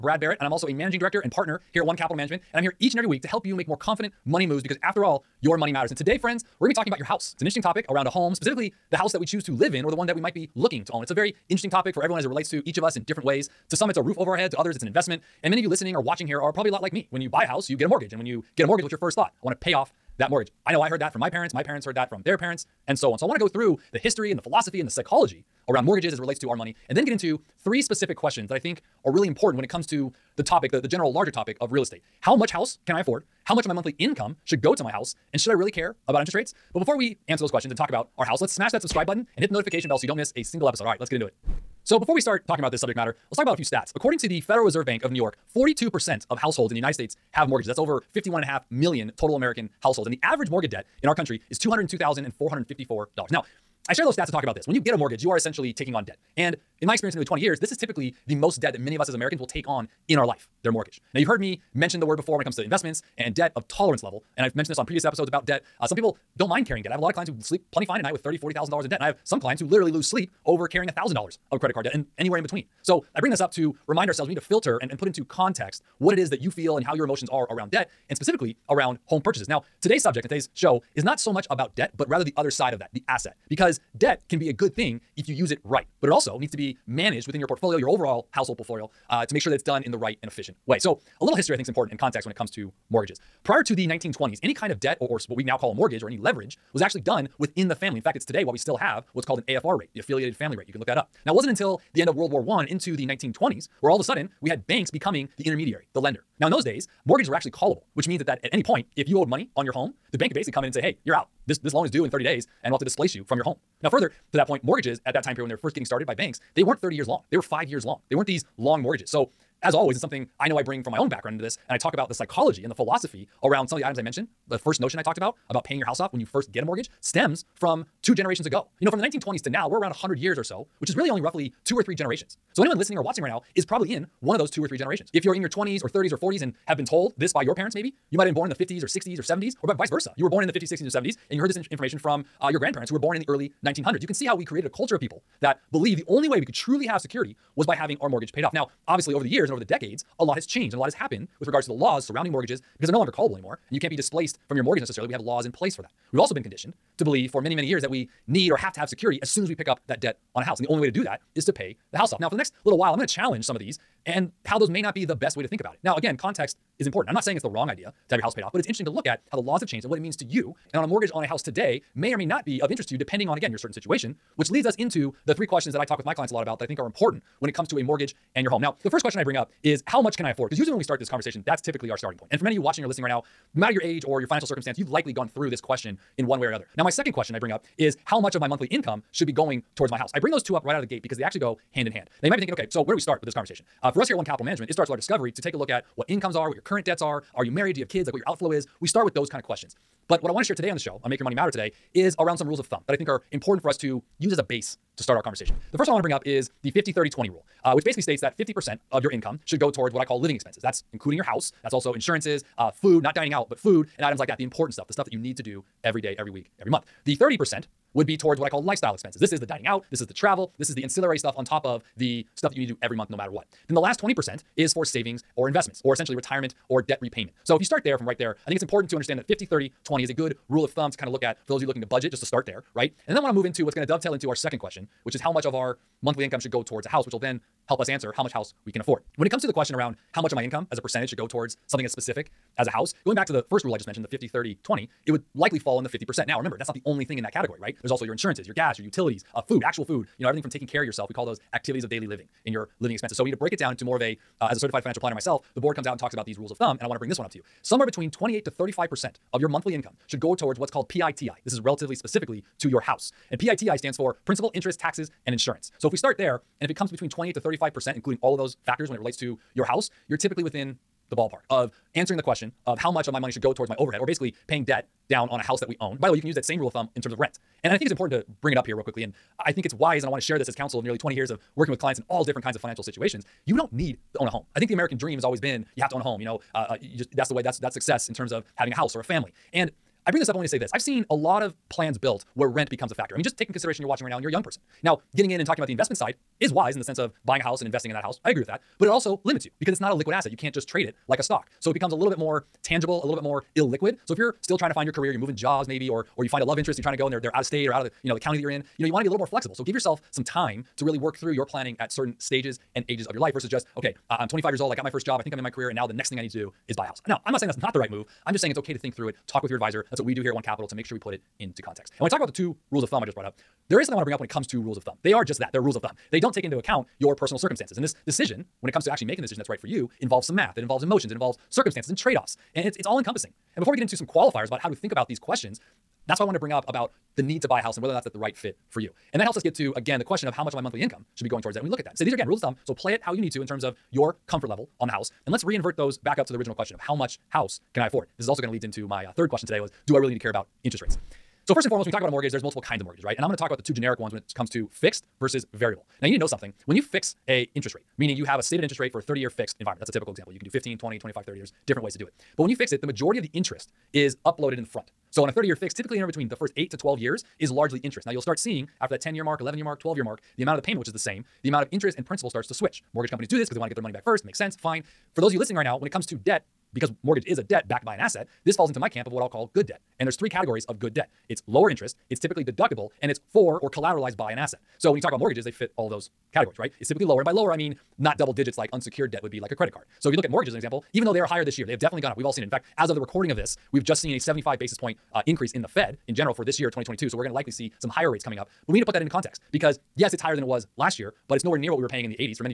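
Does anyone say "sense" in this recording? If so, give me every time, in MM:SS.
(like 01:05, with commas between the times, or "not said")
04:56, 06:14.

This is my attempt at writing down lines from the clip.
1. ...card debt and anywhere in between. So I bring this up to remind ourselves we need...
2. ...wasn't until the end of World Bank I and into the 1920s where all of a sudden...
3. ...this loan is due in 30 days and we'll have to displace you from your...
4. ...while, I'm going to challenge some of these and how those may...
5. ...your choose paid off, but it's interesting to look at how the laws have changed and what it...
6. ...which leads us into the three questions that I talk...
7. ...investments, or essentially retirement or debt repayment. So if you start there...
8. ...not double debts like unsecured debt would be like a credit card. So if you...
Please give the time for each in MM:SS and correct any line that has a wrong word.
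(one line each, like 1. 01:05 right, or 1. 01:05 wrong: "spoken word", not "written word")
1. 01:11 right
2. 01:41 wrong: "War", not "Bank"
3. 01:51 right
4. 02:42 right
5. 02:48 wrong: "house", not "choose"
6. 02:54 right
7. 03:45 right
8. 06:27 wrong: "digits", not "debts".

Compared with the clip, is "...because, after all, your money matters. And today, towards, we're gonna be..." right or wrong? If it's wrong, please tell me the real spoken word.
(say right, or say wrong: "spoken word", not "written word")
wrong: "friends", not "towards".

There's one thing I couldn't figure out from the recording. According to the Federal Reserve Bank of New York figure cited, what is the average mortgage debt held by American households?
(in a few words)
$202,454.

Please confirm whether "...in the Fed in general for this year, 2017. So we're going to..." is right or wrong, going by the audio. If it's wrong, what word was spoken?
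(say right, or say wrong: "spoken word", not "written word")
wrong: "2022", not "2017".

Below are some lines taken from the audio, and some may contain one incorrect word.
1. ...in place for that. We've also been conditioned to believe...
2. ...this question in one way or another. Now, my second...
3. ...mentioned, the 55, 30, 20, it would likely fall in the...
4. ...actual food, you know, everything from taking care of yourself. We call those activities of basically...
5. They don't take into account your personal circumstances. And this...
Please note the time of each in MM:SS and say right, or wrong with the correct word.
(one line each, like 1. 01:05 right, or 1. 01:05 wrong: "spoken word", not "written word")
1. 02:35 right
2. 03:05 right
3. 04:03 wrong: "50", not "55"
4. 04:09 wrong: "daily", not "basically"
5. 05:26 right.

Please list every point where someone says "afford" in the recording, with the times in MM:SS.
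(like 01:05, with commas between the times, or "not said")
00:32, 03:00, 03:58, 05:47.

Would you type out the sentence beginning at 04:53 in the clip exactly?
I mean, just take in consideration you're watching right now and you're a young person.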